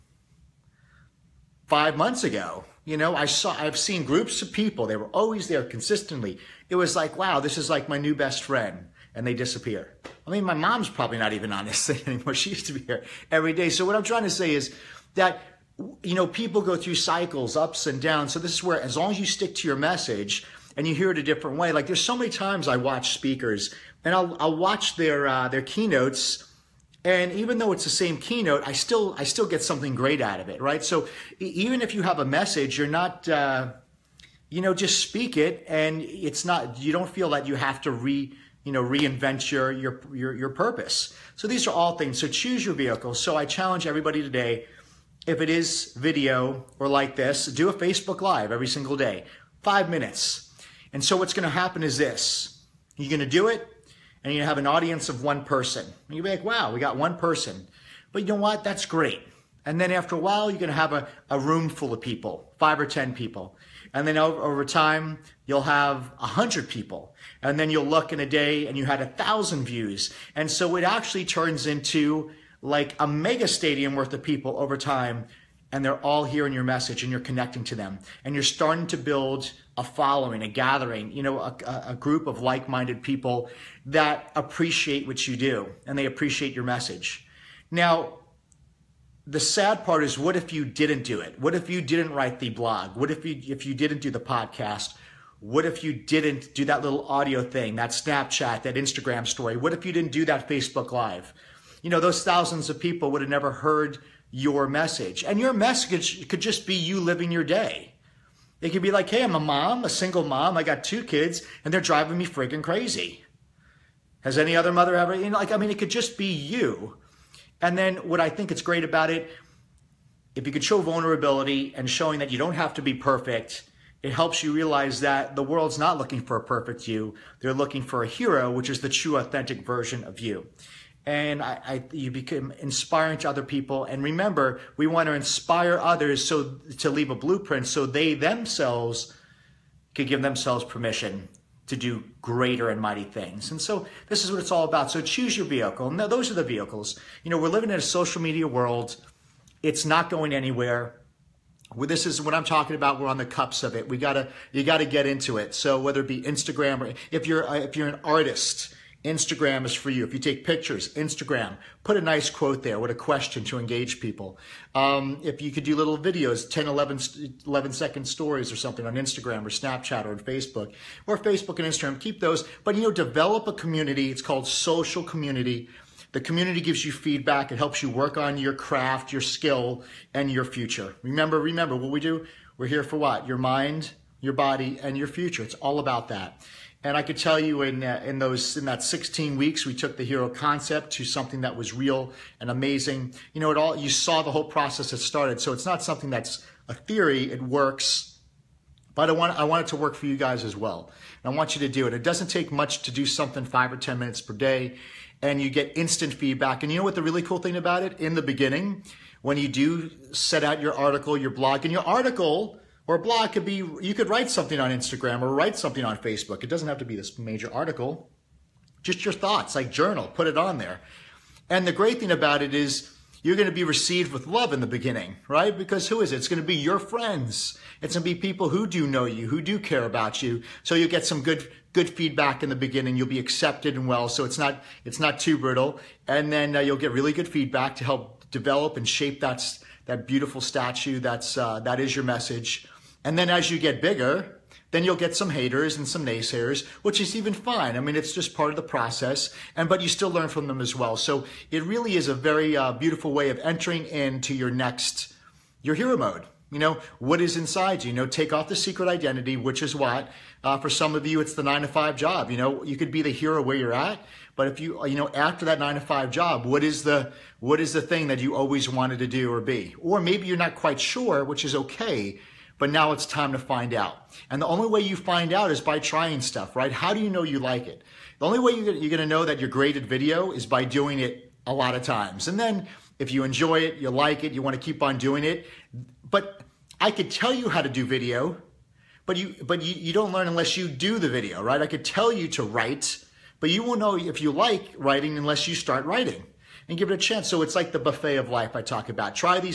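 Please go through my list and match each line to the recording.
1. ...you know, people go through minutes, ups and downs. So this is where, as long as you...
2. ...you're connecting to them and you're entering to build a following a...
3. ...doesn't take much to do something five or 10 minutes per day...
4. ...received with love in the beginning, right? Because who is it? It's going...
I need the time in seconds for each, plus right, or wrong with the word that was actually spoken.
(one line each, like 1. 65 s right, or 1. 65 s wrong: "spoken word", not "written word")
1. 16 s wrong: "cycles", not "minutes"
2. 77 s wrong: "starting", not "entering"
3. 202 s right
4. 223 s right.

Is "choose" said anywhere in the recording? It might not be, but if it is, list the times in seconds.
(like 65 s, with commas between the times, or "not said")
42 s, 145 s.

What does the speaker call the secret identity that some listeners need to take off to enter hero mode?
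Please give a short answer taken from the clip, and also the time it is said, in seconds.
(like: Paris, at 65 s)
the nine to five job, at 261 s.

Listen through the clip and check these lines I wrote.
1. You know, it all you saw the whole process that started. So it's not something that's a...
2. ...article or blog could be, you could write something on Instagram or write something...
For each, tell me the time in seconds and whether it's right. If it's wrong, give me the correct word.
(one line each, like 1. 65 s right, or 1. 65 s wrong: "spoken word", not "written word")
1. 193 s right
2. 211 s right.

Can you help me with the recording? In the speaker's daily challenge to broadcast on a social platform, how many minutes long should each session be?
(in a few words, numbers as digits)
5.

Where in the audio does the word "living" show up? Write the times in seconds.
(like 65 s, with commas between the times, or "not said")
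107 s, 147 s.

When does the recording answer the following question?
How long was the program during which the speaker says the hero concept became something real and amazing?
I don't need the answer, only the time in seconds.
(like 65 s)
188 s.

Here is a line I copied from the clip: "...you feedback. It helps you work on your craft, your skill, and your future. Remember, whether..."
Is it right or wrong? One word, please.
wrong.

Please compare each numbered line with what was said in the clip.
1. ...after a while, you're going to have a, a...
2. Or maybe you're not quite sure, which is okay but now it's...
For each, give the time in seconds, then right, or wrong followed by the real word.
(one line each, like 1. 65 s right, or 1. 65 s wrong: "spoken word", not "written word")
1. 59 s right
2. 269 s right.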